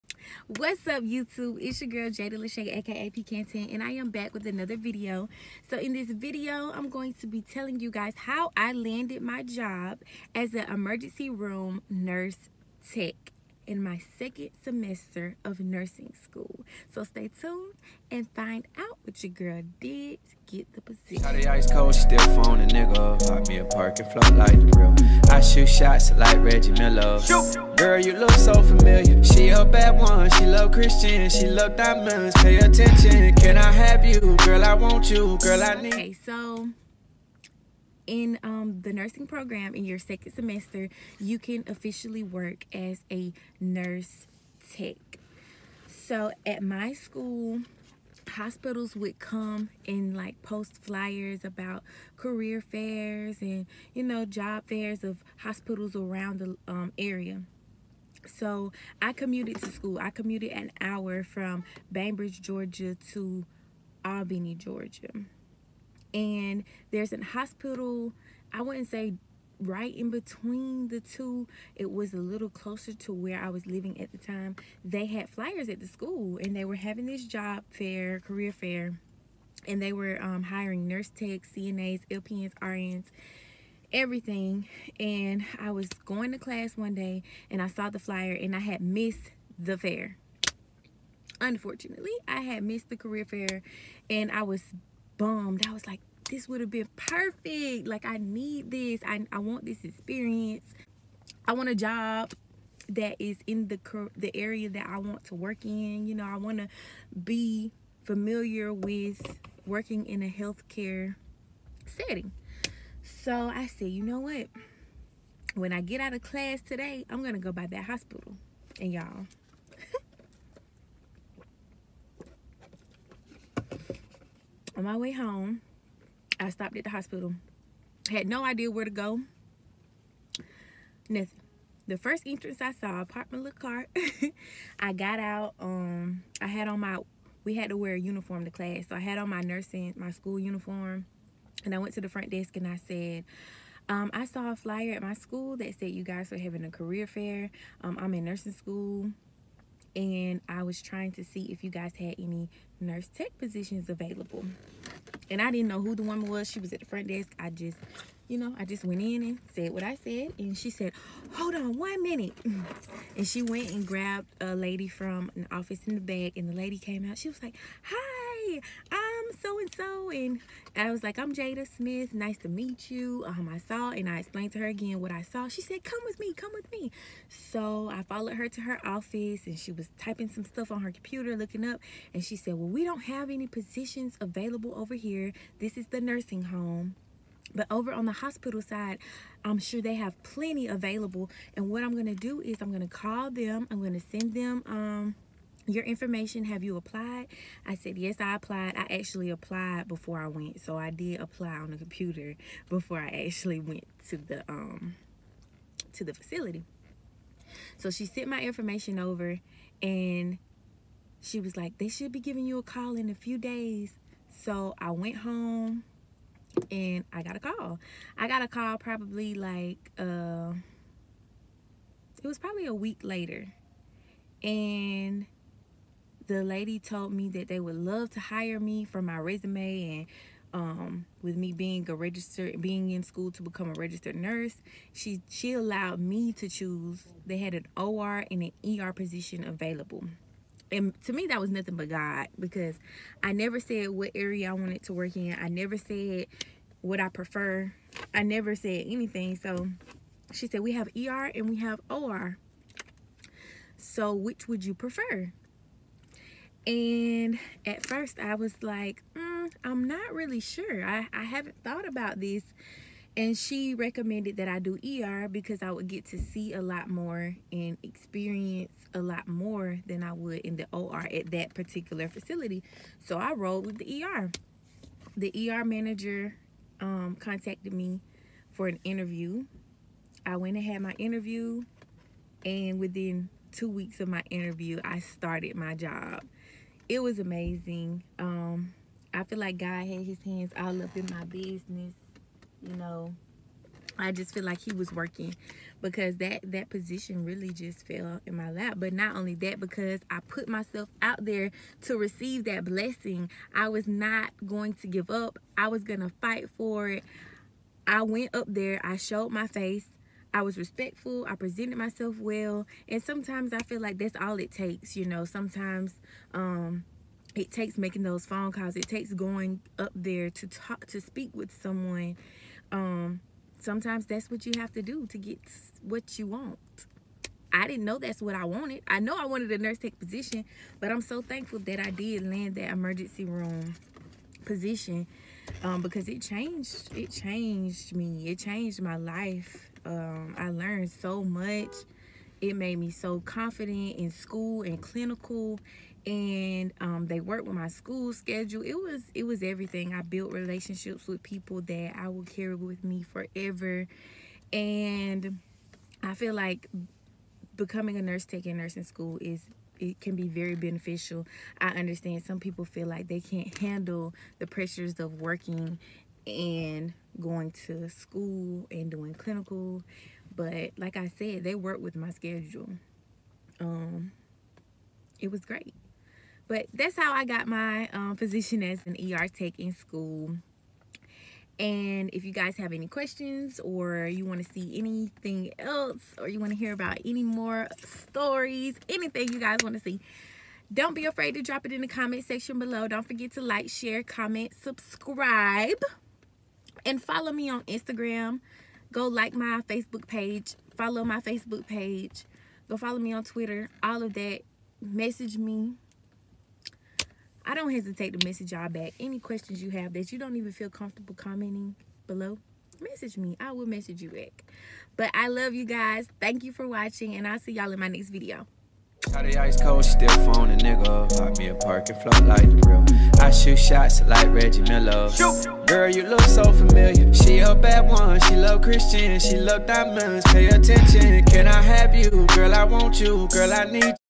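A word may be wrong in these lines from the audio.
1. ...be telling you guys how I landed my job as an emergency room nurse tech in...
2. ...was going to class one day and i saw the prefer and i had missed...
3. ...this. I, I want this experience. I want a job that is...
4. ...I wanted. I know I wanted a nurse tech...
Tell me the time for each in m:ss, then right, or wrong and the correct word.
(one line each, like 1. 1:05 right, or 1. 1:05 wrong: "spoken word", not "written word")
1. 0:07 right
2. 1:25 wrong: "flyer", not "prefer"
3. 1:38 right
4. 5:28 right.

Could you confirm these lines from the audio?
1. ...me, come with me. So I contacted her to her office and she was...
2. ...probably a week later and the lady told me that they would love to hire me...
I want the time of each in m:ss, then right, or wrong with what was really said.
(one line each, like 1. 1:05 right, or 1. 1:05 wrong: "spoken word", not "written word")
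1. 2:56 wrong: "followed", not "contacted"
2. 3:42 right.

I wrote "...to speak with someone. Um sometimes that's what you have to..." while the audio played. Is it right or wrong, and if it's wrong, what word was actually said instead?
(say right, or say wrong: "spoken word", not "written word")
right.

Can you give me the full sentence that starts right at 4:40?
I went and had my interview, and within two weeks of my interview, I started my job it was amazing.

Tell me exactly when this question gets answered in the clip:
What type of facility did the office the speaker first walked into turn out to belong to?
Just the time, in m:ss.
3:05.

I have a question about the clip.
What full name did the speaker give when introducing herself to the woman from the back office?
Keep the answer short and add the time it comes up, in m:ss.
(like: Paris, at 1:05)
Jada Smith, at 2:51.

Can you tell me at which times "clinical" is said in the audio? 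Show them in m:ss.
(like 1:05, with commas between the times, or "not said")
5:44, 6:09.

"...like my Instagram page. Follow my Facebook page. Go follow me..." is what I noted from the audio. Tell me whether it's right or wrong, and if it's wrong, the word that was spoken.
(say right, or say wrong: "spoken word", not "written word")
wrong: "Facebook", not "Instagram".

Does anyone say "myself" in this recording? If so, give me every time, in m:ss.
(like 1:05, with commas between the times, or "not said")
5:00, 5:11.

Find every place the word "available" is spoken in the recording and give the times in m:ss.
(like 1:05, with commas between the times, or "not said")
2:33, 3:04, 3:10, 3:59.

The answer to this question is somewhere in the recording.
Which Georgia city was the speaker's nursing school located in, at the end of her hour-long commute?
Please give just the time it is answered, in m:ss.
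1:04.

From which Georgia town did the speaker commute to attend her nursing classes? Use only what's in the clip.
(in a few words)
Bainbridge.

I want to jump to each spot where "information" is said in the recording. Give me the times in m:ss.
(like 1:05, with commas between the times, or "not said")
3:15, 3:28.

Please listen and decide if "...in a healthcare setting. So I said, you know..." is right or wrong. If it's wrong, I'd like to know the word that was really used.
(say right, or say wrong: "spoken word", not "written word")
right.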